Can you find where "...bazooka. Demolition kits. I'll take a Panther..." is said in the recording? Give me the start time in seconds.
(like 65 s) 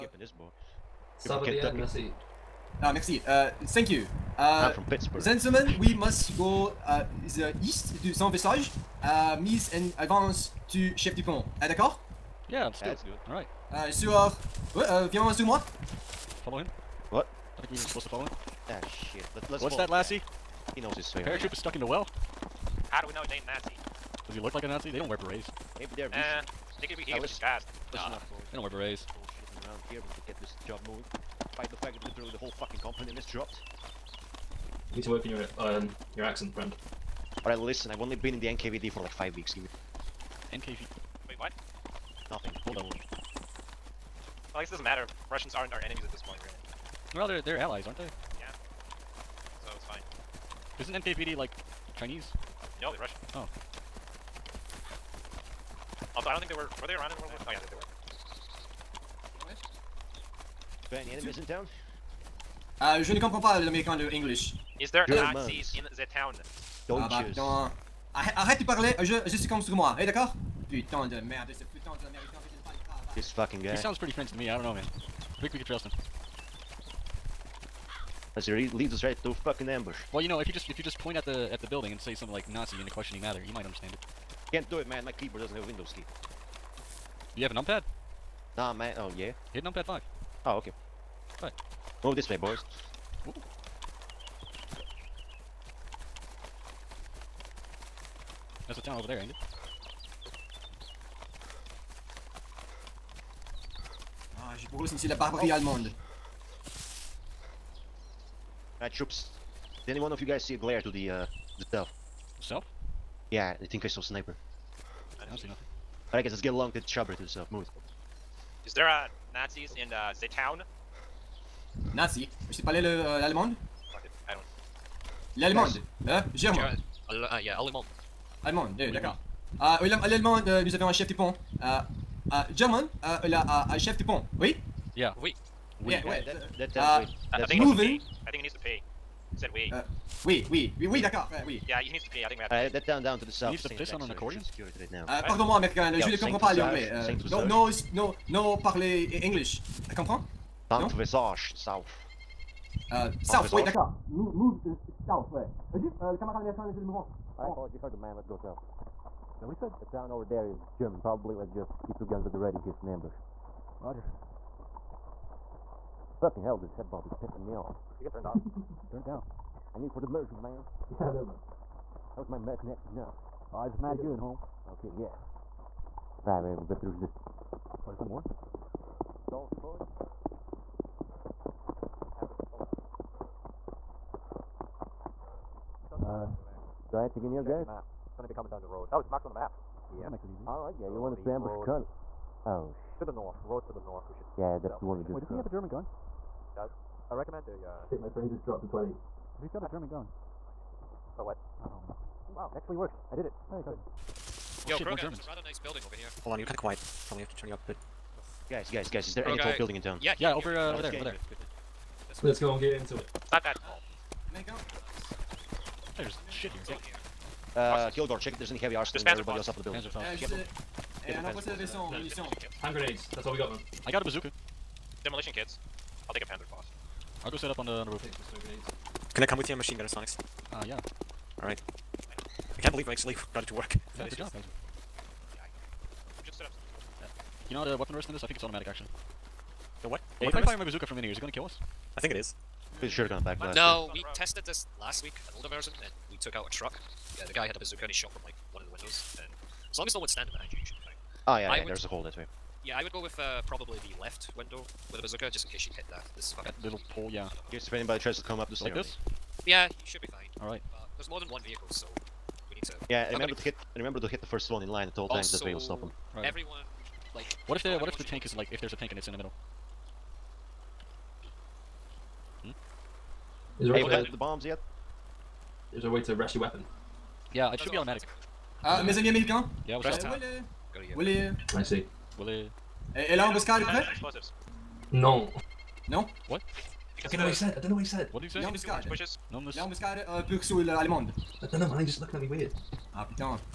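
224 s.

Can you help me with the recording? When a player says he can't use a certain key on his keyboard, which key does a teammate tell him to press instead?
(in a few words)
numpad 5.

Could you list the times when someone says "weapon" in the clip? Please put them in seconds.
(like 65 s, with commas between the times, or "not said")
237 s, 276 s.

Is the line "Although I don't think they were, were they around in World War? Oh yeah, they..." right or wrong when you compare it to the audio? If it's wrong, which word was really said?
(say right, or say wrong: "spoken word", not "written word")
right.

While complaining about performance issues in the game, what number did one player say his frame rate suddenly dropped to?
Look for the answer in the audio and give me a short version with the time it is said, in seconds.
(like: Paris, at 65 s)
20, at 198 s.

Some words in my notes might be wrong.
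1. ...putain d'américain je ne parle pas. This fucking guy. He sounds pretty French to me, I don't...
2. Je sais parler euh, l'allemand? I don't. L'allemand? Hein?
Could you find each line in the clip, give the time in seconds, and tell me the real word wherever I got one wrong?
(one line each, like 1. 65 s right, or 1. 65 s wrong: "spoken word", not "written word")
1. 71 s right
2. 122 s right.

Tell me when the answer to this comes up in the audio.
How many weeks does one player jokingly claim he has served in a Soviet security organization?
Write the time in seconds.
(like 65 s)
39 s.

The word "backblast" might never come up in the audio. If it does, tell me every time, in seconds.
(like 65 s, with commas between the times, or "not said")
243 s.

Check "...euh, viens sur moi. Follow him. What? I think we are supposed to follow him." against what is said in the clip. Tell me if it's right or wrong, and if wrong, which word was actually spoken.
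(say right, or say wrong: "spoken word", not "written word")
right.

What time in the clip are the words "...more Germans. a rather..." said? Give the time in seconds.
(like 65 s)
204 s.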